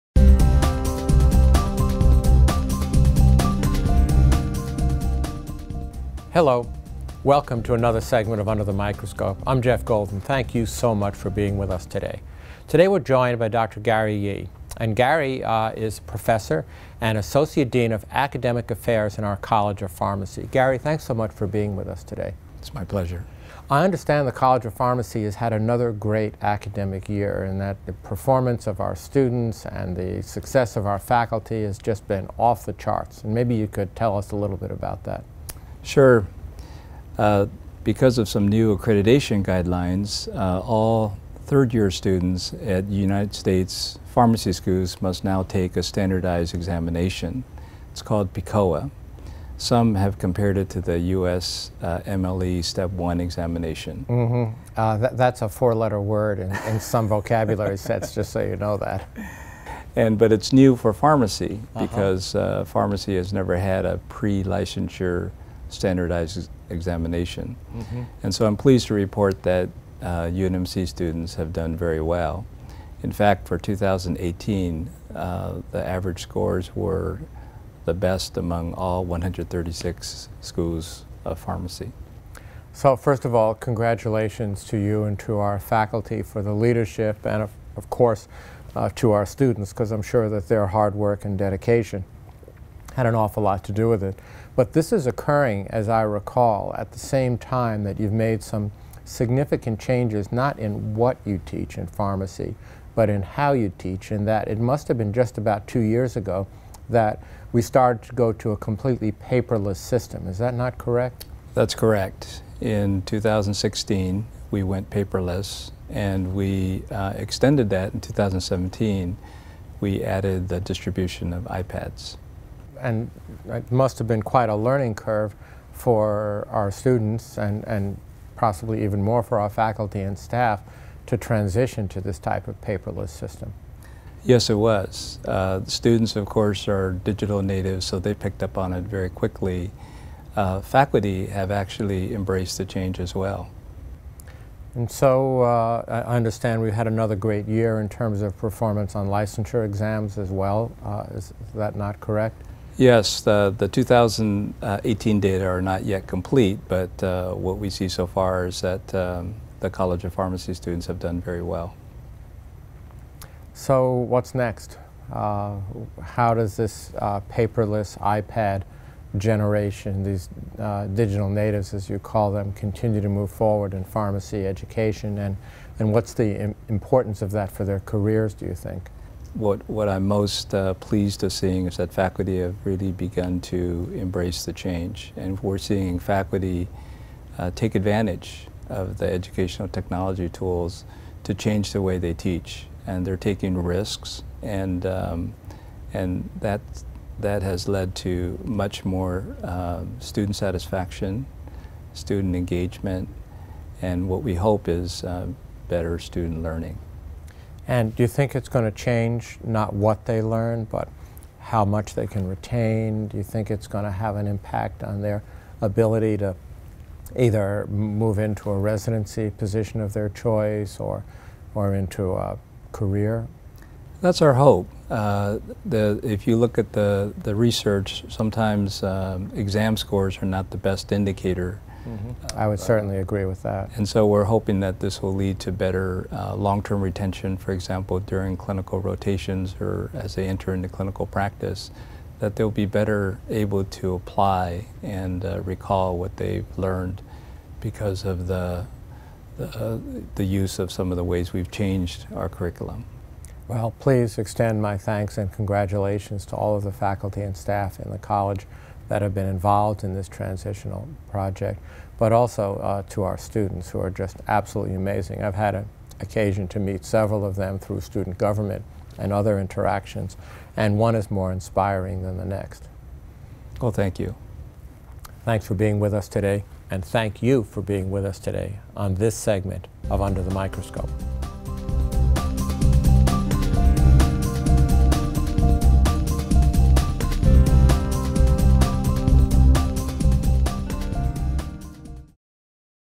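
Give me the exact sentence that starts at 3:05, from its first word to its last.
And we're seeing faculty uh, take advantage of the educational technology tools to change the way they teach.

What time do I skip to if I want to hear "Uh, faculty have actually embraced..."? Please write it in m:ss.
2:20.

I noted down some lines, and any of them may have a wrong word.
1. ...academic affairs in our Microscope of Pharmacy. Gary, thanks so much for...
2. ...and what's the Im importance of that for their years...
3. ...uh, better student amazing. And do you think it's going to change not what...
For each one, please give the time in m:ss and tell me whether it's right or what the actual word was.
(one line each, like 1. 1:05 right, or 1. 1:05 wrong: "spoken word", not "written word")
1. 0:18 wrong: "College", not "Microscope"
2. 2:55 wrong: "careers", not "years"
3. 3:25 wrong: "learning", not "amazing".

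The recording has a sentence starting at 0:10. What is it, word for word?
Thank you so much for being with us today.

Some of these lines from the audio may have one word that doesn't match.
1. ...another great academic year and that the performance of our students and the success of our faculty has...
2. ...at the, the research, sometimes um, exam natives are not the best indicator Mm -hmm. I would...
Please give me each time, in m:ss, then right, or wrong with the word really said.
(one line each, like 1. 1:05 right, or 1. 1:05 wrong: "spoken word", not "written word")
1. 0:25 right
2. 3:46 wrong: "scores", not "natives".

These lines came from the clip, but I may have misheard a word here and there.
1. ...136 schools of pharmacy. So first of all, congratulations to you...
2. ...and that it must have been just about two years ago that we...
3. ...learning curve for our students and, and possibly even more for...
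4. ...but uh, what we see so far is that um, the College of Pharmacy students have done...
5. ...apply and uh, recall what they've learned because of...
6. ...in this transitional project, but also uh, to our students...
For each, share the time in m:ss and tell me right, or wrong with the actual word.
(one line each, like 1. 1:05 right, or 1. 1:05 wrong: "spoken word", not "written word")
1. 1:19 right
2. 1:44 right
3. 2:04 right
4. 2:36 right
5. 4:03 right
6. 4:19 right.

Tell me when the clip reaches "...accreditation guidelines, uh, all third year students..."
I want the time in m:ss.
0:38.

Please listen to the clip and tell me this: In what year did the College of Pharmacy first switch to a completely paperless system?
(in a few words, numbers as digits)
2016.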